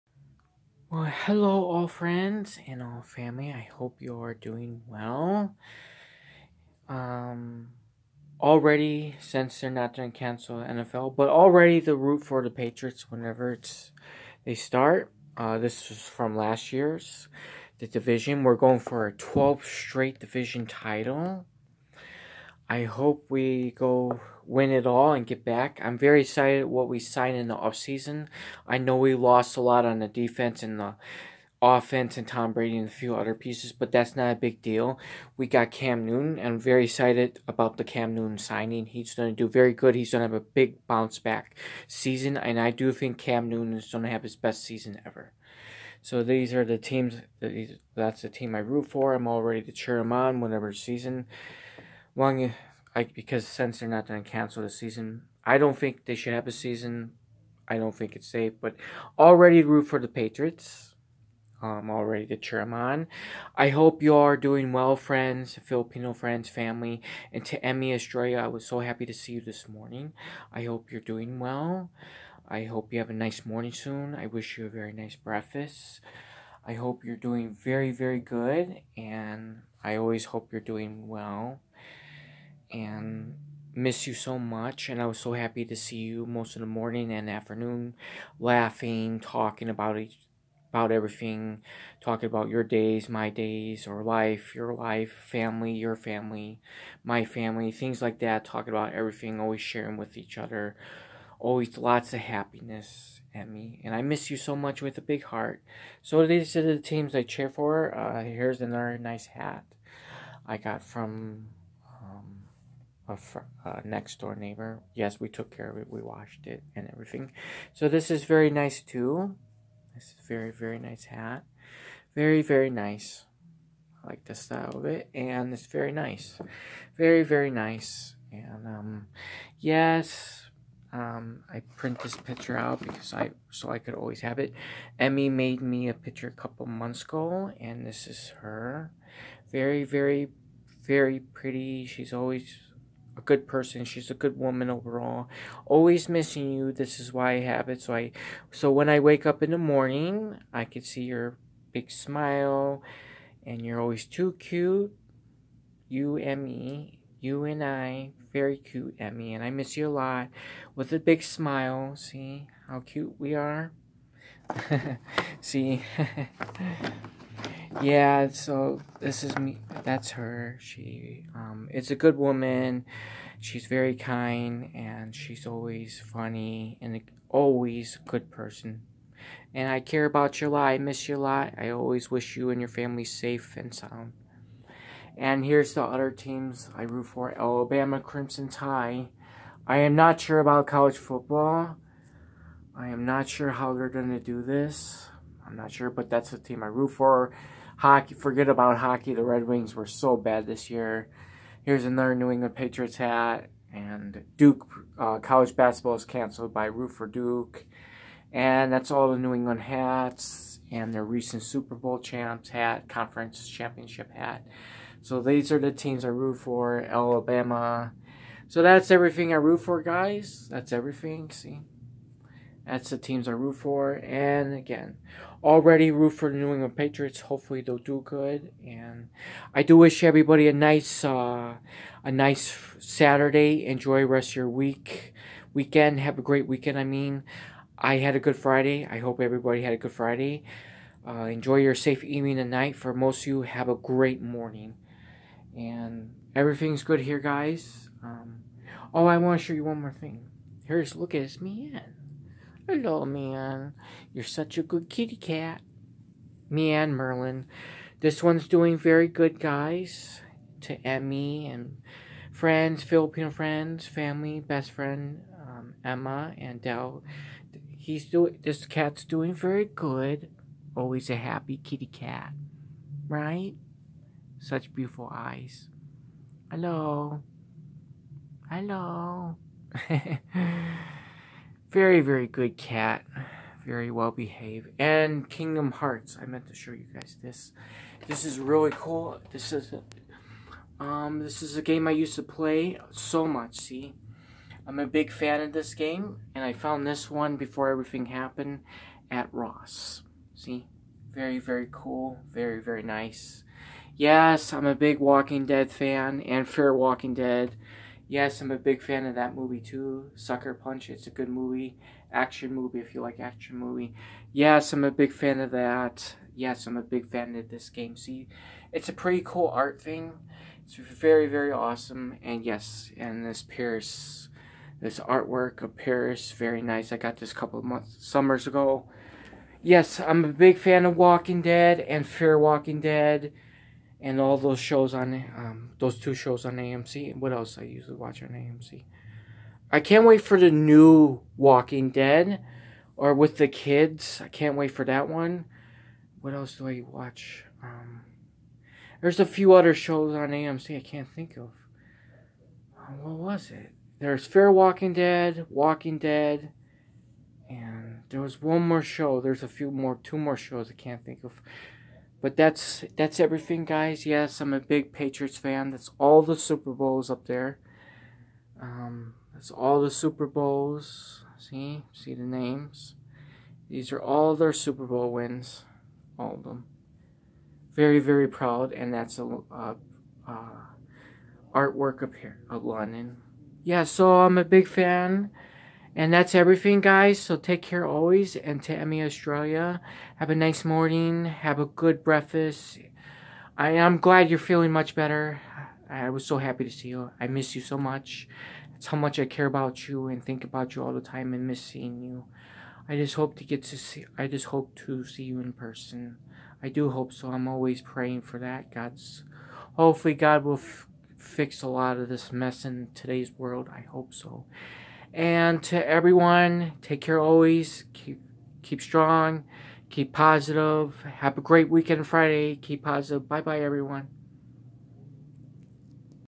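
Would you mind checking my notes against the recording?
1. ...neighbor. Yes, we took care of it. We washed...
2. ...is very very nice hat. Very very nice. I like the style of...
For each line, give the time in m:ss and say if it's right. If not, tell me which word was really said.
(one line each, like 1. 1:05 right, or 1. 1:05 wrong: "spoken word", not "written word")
1. 1:54 right
2. 2:00 right.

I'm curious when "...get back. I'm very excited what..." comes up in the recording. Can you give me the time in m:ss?
0:25.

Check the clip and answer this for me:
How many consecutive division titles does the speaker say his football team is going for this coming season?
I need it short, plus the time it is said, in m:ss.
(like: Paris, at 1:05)
12, at 0:19.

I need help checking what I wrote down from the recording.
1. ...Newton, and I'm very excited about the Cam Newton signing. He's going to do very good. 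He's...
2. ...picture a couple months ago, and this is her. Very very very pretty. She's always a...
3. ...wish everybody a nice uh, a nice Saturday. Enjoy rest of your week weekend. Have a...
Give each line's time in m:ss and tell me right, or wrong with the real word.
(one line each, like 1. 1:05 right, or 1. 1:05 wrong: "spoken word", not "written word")
1. 0:36 right
2. 2:15 right
3. 3:49 right.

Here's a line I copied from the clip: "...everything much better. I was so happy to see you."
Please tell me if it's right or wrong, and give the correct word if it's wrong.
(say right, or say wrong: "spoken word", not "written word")
wrong: "feeling", not "everything".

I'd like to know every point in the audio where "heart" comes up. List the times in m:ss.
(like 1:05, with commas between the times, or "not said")
1:45, 4:45.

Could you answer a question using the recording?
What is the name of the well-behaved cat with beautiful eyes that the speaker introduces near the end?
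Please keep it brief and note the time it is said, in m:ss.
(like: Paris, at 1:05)
Merlin, at 4:16.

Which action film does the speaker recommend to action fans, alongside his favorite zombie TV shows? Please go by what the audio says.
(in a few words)
Sucker Punch.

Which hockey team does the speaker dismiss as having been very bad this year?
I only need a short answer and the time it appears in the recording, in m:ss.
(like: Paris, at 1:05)
Red Wings, at 3:19.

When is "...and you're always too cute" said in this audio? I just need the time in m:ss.
2:33.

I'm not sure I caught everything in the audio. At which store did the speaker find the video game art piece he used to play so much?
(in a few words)
Ross.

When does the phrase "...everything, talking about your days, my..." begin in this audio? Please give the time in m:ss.
1:30.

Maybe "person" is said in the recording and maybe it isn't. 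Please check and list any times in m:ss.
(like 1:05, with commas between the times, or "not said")
2:23, 2:58, 6:45.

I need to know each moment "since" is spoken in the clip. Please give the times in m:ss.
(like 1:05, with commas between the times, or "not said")
0:09, 0:53.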